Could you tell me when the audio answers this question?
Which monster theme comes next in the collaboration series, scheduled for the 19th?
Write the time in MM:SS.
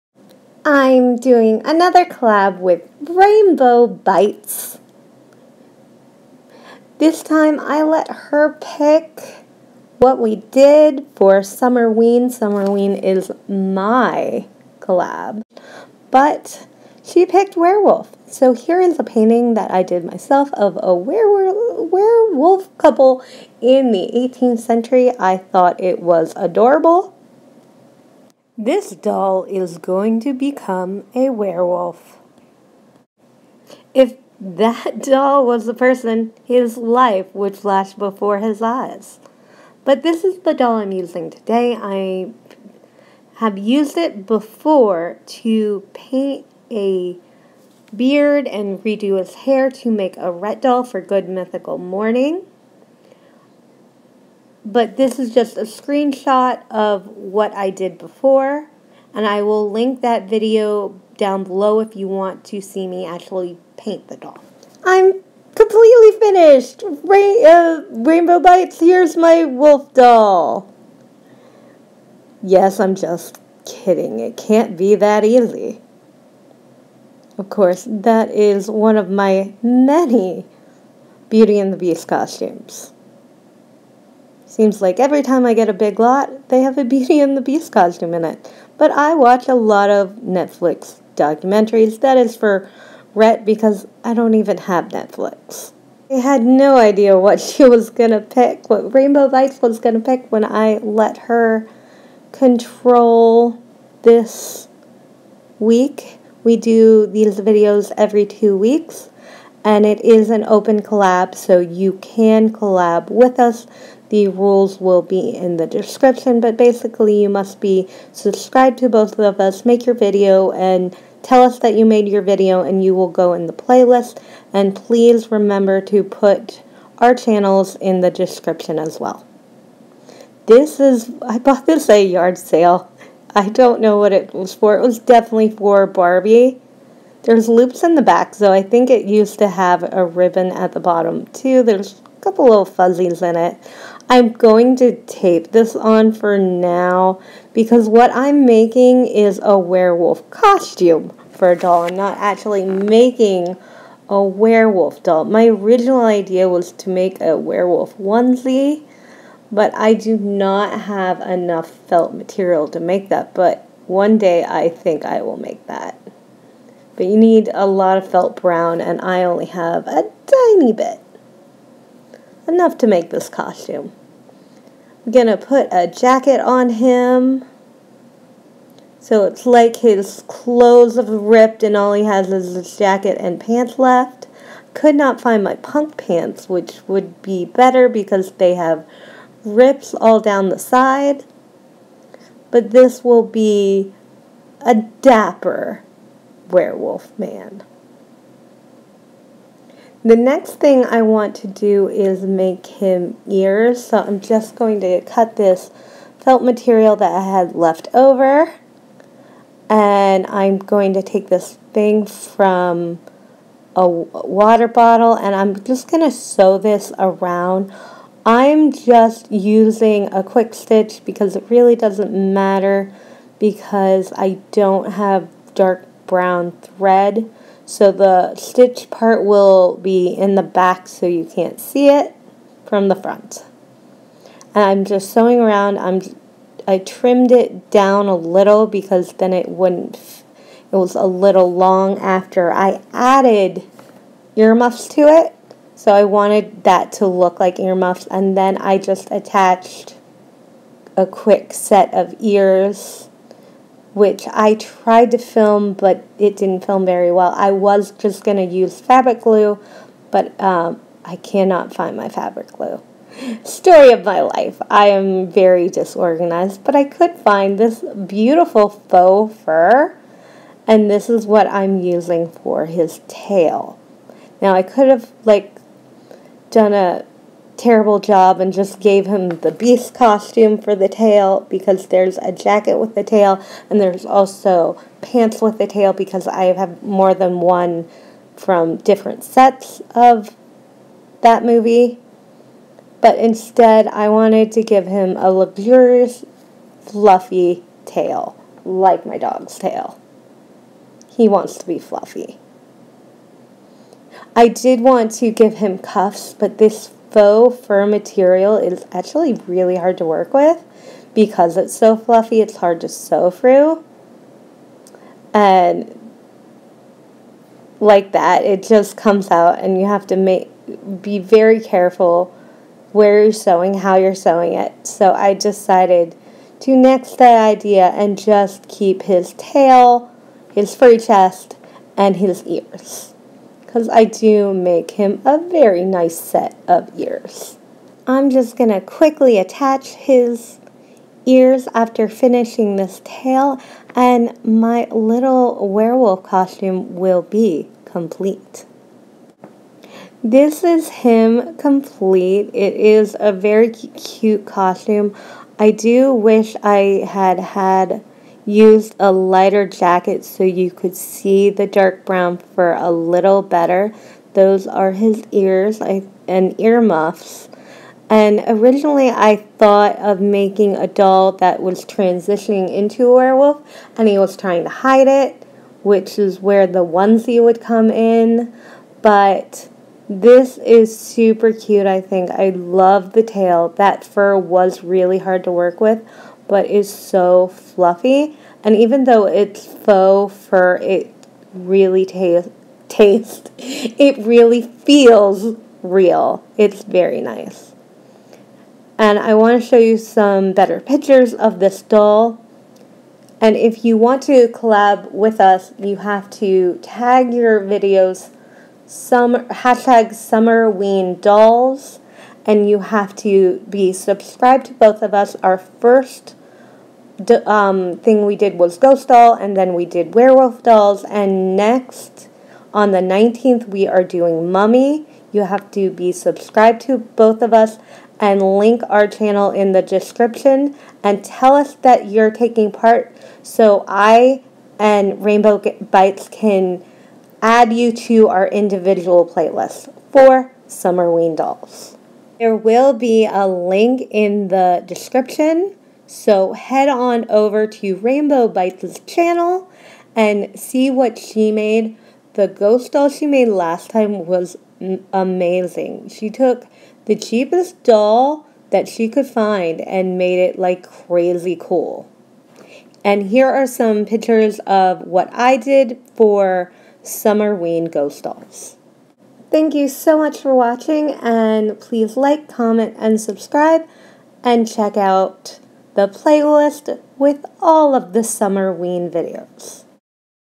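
07:04.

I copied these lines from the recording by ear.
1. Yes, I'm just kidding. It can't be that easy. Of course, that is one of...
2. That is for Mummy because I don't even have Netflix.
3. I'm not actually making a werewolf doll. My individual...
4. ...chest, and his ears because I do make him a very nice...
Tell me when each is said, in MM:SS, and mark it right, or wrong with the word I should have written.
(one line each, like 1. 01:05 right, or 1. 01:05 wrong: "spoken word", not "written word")
1. 01:12 right
2. 01:32 wrong: "Rhett", not "Mummy"
3. 02:31 wrong: "original", not "individual"
4. 05:30 right.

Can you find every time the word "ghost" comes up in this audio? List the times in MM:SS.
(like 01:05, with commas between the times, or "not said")
06:58, 07:32, 07:47.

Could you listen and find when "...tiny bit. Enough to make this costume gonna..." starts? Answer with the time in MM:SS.
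02:50.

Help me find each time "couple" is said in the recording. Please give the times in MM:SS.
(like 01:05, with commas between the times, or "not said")
00:22, 02:22.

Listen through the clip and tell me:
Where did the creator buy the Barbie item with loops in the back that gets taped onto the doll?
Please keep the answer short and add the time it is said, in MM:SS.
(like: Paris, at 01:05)
a yard sale, at 02:11.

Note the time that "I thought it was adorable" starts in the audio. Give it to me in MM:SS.
00:25.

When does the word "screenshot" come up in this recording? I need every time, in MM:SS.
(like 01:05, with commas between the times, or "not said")
00:55.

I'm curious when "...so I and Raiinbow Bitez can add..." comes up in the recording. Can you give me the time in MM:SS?
07:13.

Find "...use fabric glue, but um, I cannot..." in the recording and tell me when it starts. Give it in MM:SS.
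04:18.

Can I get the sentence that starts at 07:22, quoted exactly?
There will be a link in the description so head on over to Raiinbow Bitez' channel and see what she made.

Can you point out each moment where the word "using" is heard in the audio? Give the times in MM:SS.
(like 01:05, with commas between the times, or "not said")
00:40, 03:39, 04:31.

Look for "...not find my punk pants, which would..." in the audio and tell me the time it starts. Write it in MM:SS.
03:04.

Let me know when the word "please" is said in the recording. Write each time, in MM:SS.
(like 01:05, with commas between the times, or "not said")
02:04, 07:51.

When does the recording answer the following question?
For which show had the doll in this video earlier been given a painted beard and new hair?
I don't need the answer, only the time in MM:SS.
00:50.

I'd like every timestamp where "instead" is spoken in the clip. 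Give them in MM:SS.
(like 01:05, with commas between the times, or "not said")
04:53.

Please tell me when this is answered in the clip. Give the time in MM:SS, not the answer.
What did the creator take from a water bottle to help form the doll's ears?
03:31.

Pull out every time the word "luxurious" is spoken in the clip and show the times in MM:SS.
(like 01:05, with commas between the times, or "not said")
04:55.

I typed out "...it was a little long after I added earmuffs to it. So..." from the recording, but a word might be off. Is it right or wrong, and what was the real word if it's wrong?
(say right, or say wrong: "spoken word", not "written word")
right.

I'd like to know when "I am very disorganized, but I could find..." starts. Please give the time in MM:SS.
04:24.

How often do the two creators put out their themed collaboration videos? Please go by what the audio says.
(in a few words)
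every two weeks.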